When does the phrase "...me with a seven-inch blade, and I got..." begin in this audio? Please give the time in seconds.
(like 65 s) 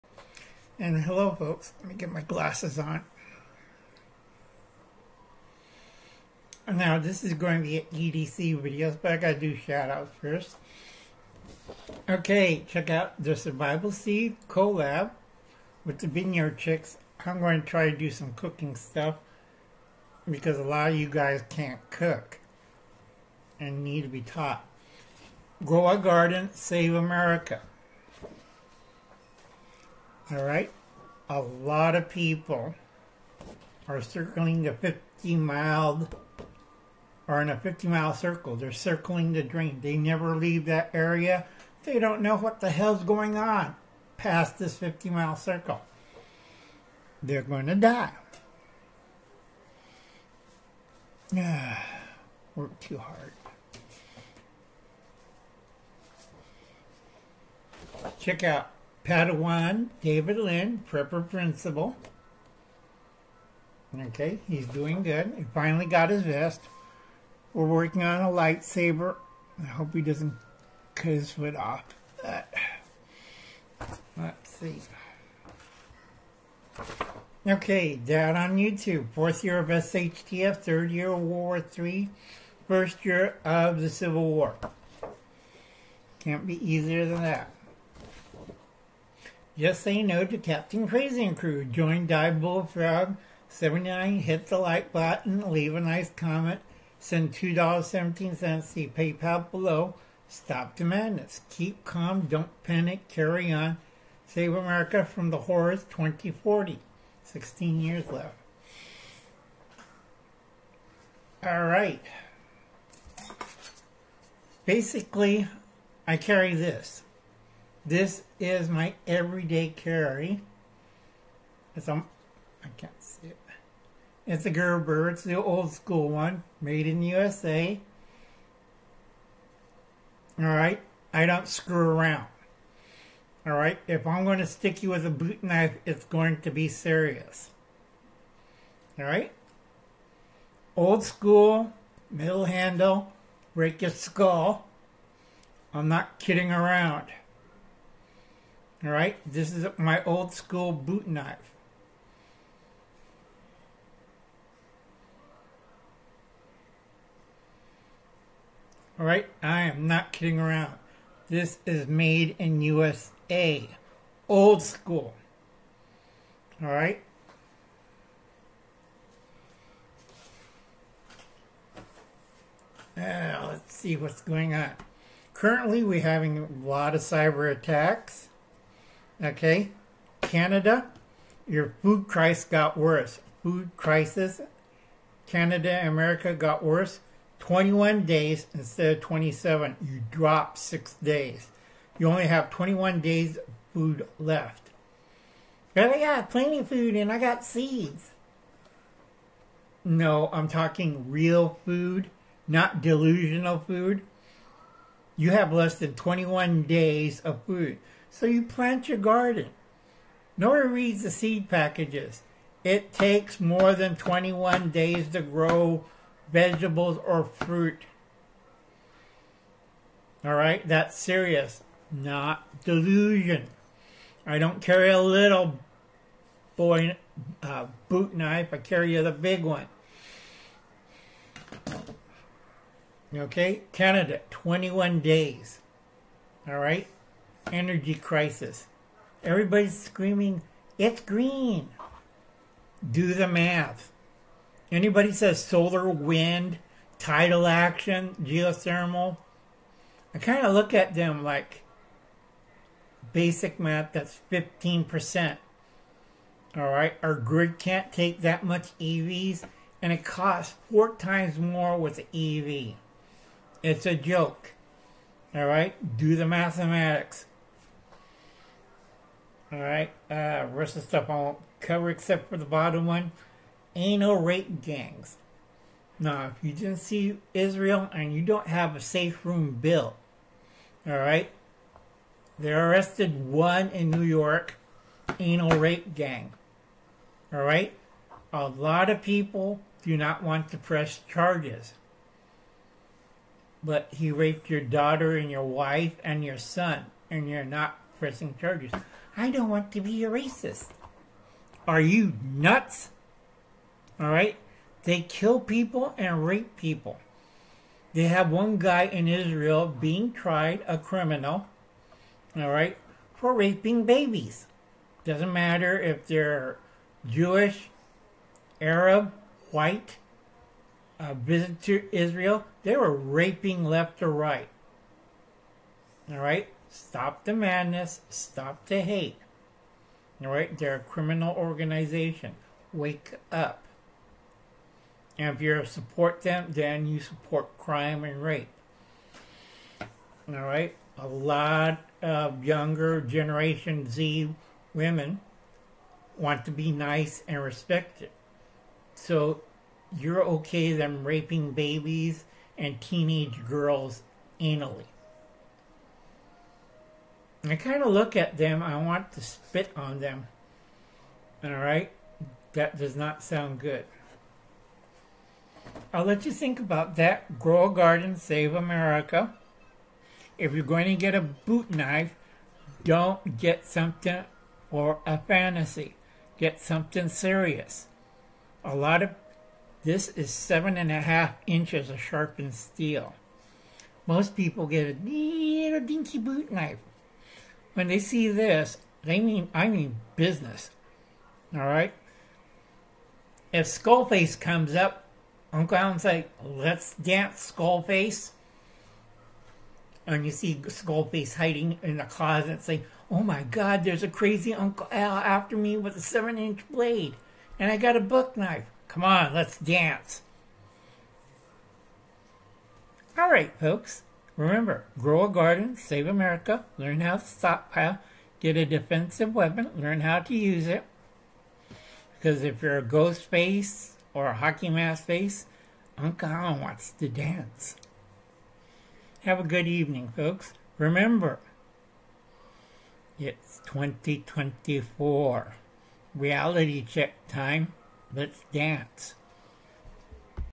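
405 s.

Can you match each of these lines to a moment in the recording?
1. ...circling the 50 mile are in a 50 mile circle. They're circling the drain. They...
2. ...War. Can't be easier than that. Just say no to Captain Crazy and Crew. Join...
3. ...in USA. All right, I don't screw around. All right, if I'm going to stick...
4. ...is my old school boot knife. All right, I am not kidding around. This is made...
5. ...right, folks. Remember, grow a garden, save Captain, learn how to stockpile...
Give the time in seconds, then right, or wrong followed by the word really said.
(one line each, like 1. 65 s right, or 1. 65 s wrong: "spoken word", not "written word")
1. 34 s right
2. 84 s right
3. 126 s right
4. 149 s right
5. 413 s wrong: "America", not "Captain".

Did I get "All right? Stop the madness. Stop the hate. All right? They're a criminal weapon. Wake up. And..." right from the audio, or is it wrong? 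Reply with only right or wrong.
wrong.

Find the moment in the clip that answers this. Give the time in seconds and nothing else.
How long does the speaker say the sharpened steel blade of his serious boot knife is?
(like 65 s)
380 s.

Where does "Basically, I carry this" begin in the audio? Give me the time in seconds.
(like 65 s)
114 s.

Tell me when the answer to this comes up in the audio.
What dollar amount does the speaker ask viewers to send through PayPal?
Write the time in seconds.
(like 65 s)
97 s.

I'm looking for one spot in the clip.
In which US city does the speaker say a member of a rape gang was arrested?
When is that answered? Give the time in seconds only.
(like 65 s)
283 s.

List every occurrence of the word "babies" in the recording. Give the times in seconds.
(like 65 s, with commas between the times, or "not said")
313 s, 351 s.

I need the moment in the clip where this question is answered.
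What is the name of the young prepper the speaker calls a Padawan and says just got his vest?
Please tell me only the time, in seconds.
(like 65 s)
60 s.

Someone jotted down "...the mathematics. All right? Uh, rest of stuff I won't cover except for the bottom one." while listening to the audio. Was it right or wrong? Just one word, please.
right.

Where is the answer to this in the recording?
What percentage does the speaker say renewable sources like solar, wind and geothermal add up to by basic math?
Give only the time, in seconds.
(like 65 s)
254 s.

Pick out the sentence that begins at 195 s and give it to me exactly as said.
But I got plenty of food and I got seeds.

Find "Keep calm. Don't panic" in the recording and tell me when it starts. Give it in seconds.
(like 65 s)
101 s.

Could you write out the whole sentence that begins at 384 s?
Most people get a little dinky boot knife.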